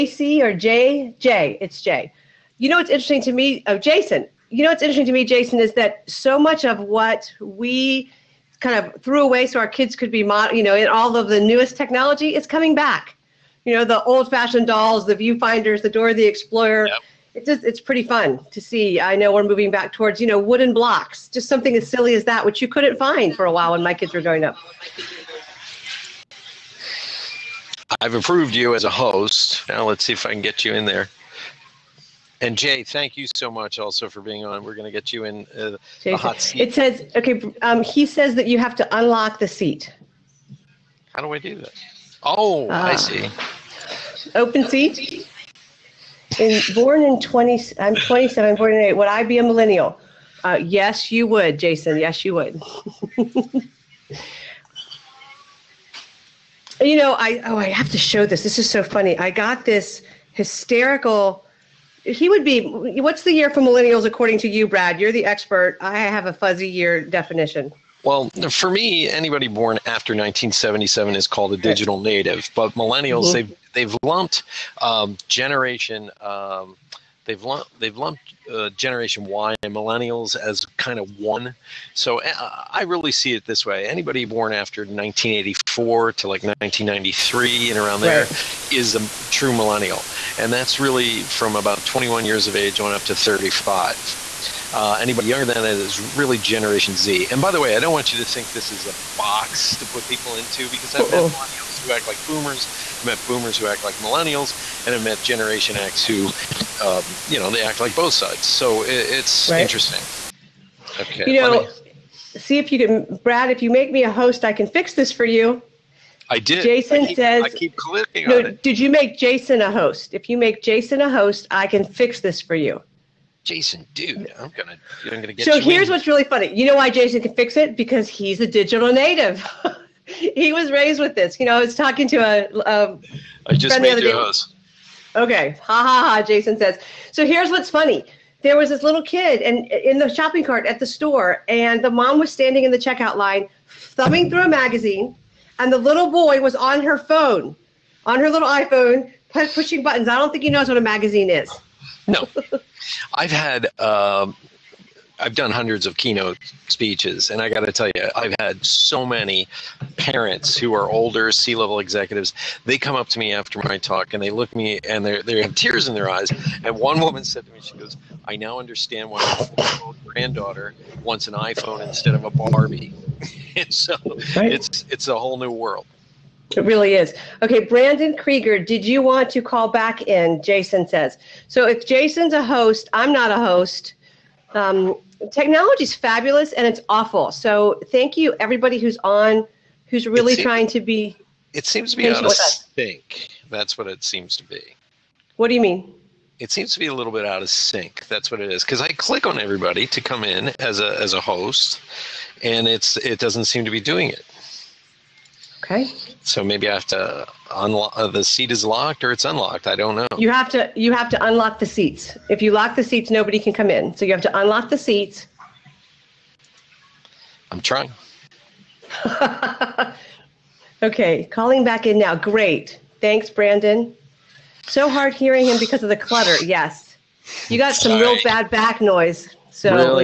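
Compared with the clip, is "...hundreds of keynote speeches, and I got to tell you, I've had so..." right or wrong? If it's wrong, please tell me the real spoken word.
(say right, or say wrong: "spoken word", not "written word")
right.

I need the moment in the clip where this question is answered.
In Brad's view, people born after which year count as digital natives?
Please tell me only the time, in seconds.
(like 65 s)
70 s.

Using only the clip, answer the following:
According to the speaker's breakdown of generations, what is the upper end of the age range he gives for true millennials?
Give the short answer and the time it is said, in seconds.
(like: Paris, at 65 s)
35, at 93 s.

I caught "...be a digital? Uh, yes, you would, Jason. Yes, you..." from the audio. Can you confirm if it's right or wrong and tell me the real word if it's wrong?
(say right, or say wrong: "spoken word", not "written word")
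wrong: "millennial", not "digital".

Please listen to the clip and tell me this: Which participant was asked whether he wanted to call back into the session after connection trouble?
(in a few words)
Brandon Krieger.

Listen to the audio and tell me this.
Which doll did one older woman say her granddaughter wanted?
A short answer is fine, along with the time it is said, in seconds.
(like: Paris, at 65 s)
Barbie, at 172 s.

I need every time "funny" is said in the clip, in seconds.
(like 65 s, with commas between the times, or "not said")
58 s, 126 s, 137 s.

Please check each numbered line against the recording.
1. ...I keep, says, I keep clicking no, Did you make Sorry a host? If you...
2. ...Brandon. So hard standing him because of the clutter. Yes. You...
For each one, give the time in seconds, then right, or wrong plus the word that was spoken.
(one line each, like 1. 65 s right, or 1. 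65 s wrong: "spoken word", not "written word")
1. 117 s wrong: "Jason", not "Sorry"
2. 223 s wrong: "hearing", not "standing".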